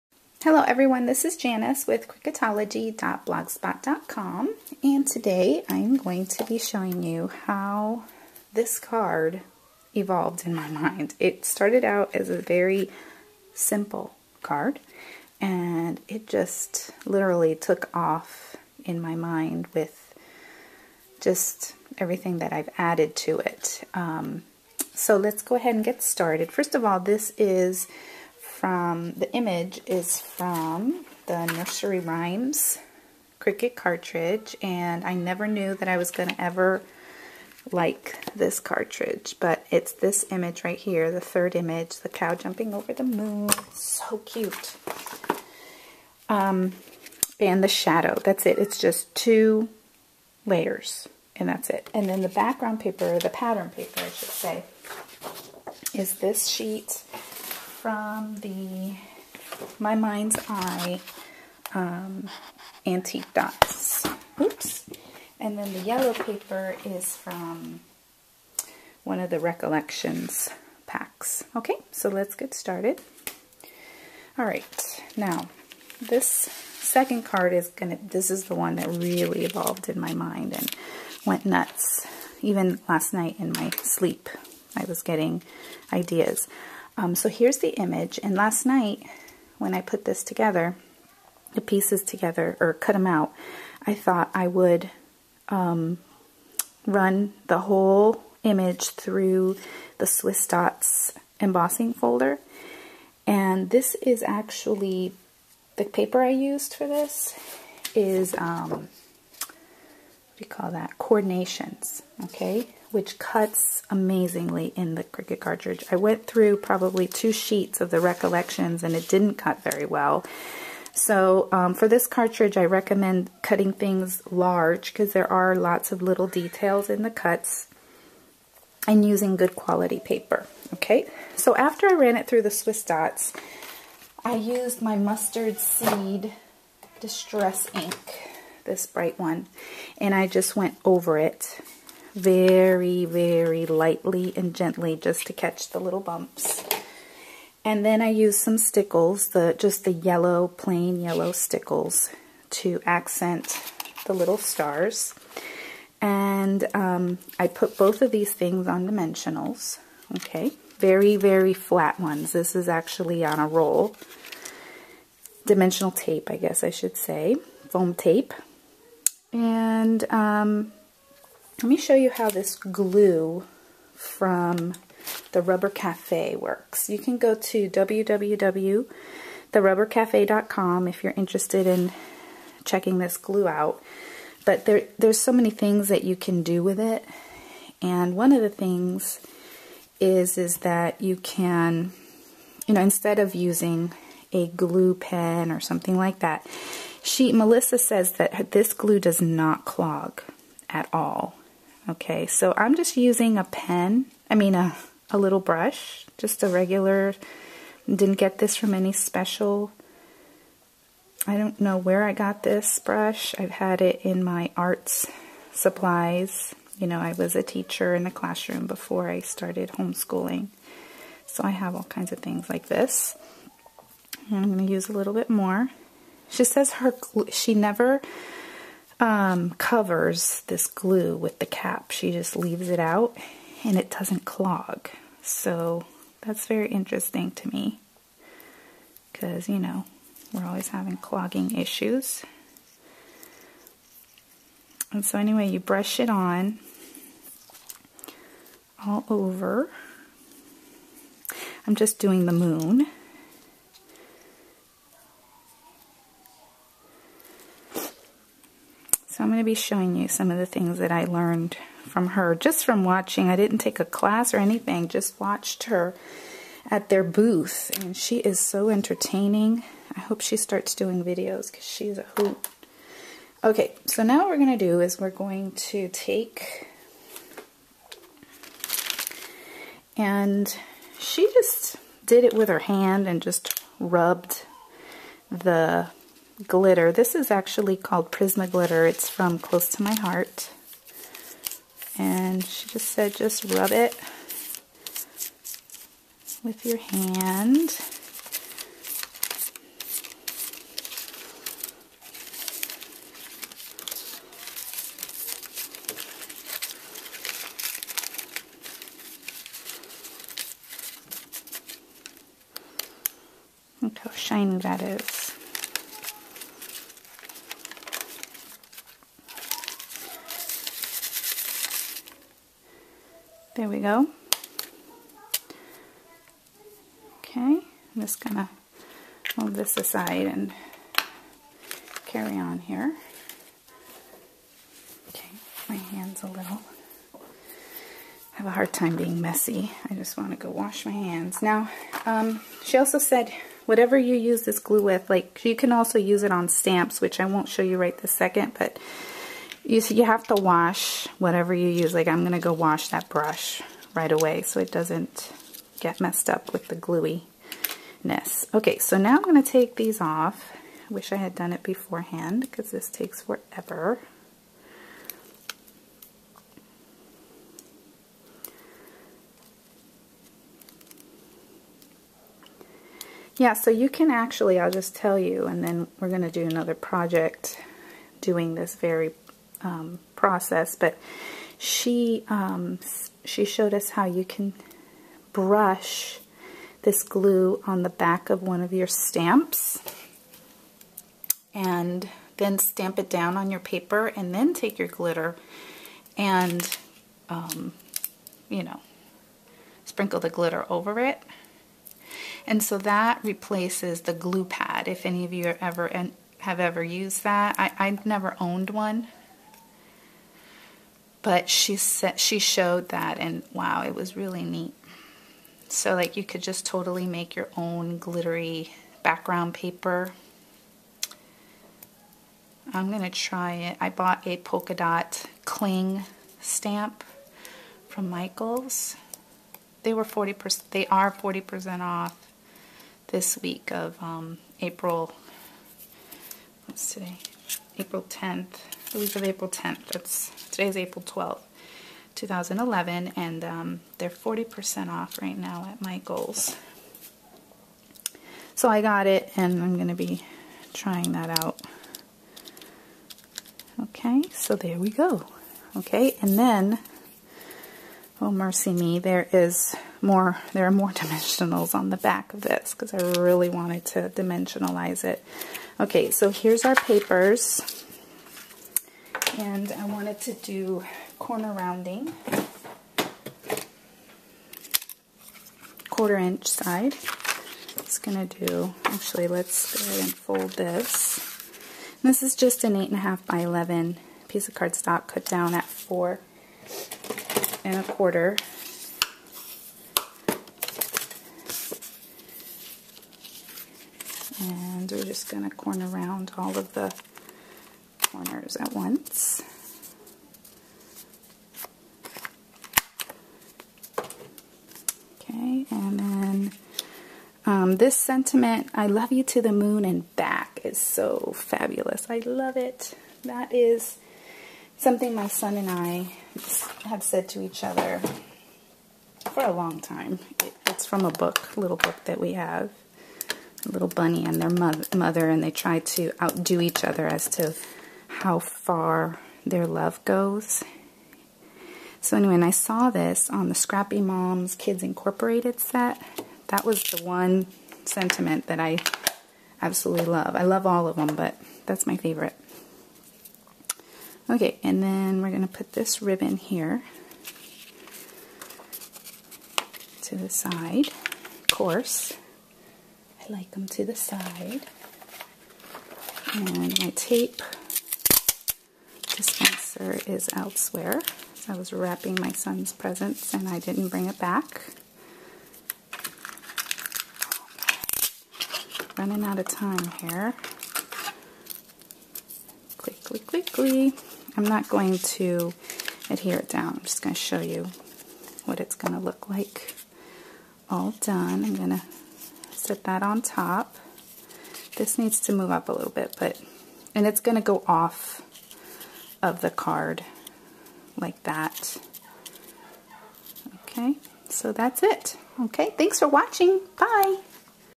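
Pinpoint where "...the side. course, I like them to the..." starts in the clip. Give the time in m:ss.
9:10.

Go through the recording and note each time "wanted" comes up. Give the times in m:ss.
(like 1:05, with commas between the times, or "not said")
7:43, 7:49.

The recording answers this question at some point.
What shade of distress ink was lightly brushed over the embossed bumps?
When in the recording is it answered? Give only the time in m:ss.
2:14.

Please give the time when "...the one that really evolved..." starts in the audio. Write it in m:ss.
1:18.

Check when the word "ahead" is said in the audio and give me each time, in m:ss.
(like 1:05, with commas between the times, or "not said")
0:25, 7:59.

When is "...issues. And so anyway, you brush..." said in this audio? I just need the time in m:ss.
4:01.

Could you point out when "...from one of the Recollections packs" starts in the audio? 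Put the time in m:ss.
1:07.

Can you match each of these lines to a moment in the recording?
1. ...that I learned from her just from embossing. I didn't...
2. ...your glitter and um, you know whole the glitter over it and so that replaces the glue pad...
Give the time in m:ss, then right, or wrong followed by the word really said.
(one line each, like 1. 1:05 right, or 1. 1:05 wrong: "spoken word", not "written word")
1. 4:20 wrong: "watching", not "embossing"
2. 6:34 wrong: "sprinkle", not "whole".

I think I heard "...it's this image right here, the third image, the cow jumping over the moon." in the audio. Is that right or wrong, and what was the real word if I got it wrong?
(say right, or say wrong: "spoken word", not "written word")
right.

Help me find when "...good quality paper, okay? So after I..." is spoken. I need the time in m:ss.
2:09.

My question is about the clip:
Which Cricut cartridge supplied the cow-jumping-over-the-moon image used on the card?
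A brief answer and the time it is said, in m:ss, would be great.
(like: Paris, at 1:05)
Nursery Rhymes, at 0:31.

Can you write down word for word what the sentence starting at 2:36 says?
And um, I put both of these things on dimensionals, okay?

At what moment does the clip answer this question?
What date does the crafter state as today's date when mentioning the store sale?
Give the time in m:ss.
7:20.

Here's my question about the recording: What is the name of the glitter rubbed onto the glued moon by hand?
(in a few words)
Prisma Glitter.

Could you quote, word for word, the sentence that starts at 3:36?
You know, I was a teacher in the classroom before I started homeschooling.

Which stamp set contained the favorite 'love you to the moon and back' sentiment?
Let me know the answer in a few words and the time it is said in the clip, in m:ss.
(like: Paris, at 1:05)
Scrappy Moms Kids Incorporated, at 8:53.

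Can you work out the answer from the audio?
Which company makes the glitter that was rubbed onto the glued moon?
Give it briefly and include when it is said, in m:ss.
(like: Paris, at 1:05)
Close to My Heart, at 4:49.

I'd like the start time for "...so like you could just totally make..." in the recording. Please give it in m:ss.
6:55.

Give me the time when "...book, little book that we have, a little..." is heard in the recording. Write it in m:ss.
8:41.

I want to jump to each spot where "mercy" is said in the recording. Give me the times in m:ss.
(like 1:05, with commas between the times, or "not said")
7:38.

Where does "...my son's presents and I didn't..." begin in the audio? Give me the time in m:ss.
9:22.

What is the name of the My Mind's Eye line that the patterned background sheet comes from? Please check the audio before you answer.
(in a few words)
Antique Dots.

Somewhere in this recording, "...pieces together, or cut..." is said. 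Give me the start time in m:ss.
1:31.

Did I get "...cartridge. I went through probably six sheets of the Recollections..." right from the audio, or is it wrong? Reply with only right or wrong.
wrong.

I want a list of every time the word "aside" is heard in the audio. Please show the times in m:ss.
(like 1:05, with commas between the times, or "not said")
5:29.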